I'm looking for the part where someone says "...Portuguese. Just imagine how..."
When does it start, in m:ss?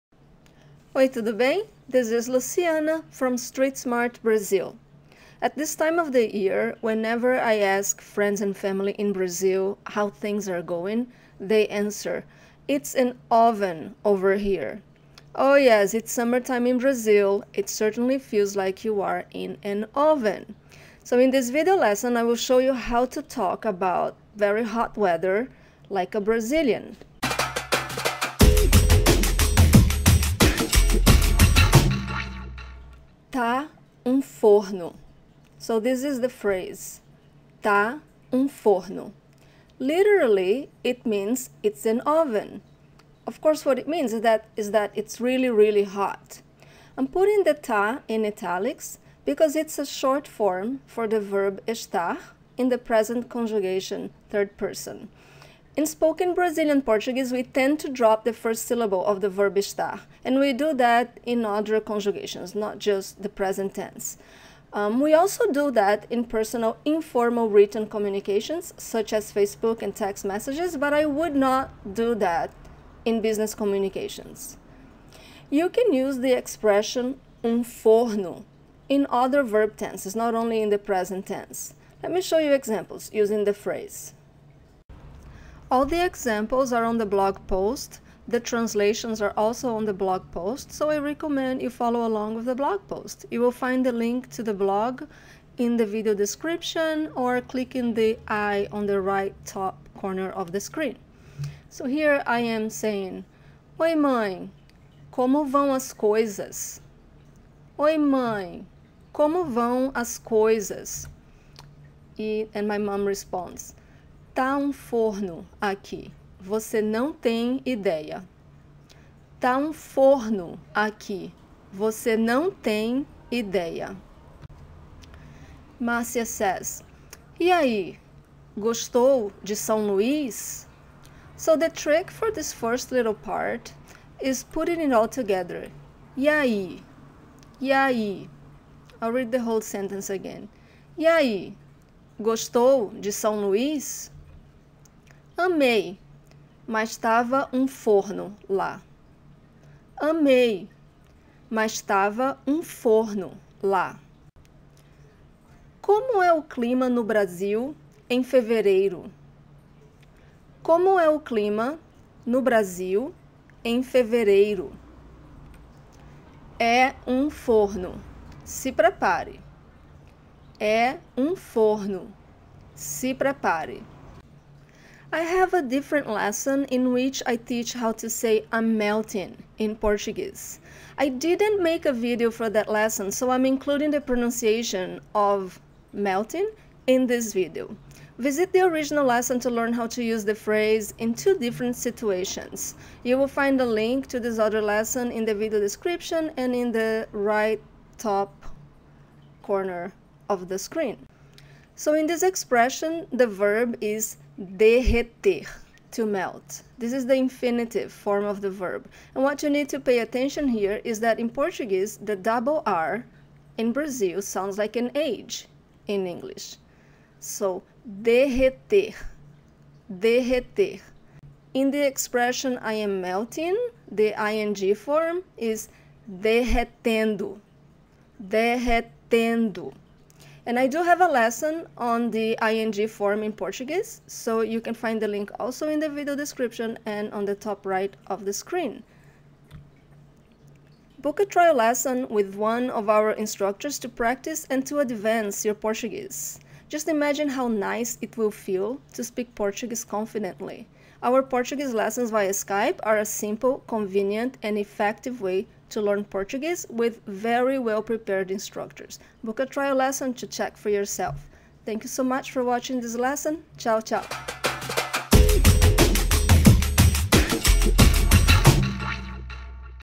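4:05.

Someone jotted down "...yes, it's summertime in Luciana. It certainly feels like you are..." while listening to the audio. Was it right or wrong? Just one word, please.
wrong.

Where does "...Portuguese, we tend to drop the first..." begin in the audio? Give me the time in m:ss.
0:56.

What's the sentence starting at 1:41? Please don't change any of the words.
So here I am saying, Oi mãe, como vão as coisas?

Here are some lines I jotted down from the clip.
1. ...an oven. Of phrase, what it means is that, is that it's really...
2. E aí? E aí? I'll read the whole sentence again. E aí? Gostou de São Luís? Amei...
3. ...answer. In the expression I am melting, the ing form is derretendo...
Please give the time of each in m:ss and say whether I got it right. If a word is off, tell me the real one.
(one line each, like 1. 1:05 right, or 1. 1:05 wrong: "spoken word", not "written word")
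1. 0:41 wrong: "course", not "phrase"
2. 2:16 right
3. 3:39 wrong: "derreter", not "answer".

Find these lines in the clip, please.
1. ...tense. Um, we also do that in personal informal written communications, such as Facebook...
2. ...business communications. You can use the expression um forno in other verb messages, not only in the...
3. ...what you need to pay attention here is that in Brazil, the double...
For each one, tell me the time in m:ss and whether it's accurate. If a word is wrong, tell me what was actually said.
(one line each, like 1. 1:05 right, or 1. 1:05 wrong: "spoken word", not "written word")
1. 1:03 right
2. 1:13 wrong: "tenses", not "messages"
3. 3:29 wrong: "Portuguese", not "Brazil".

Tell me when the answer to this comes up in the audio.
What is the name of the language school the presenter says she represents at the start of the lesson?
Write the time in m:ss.
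0:03.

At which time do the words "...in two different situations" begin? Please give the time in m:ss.
3:10.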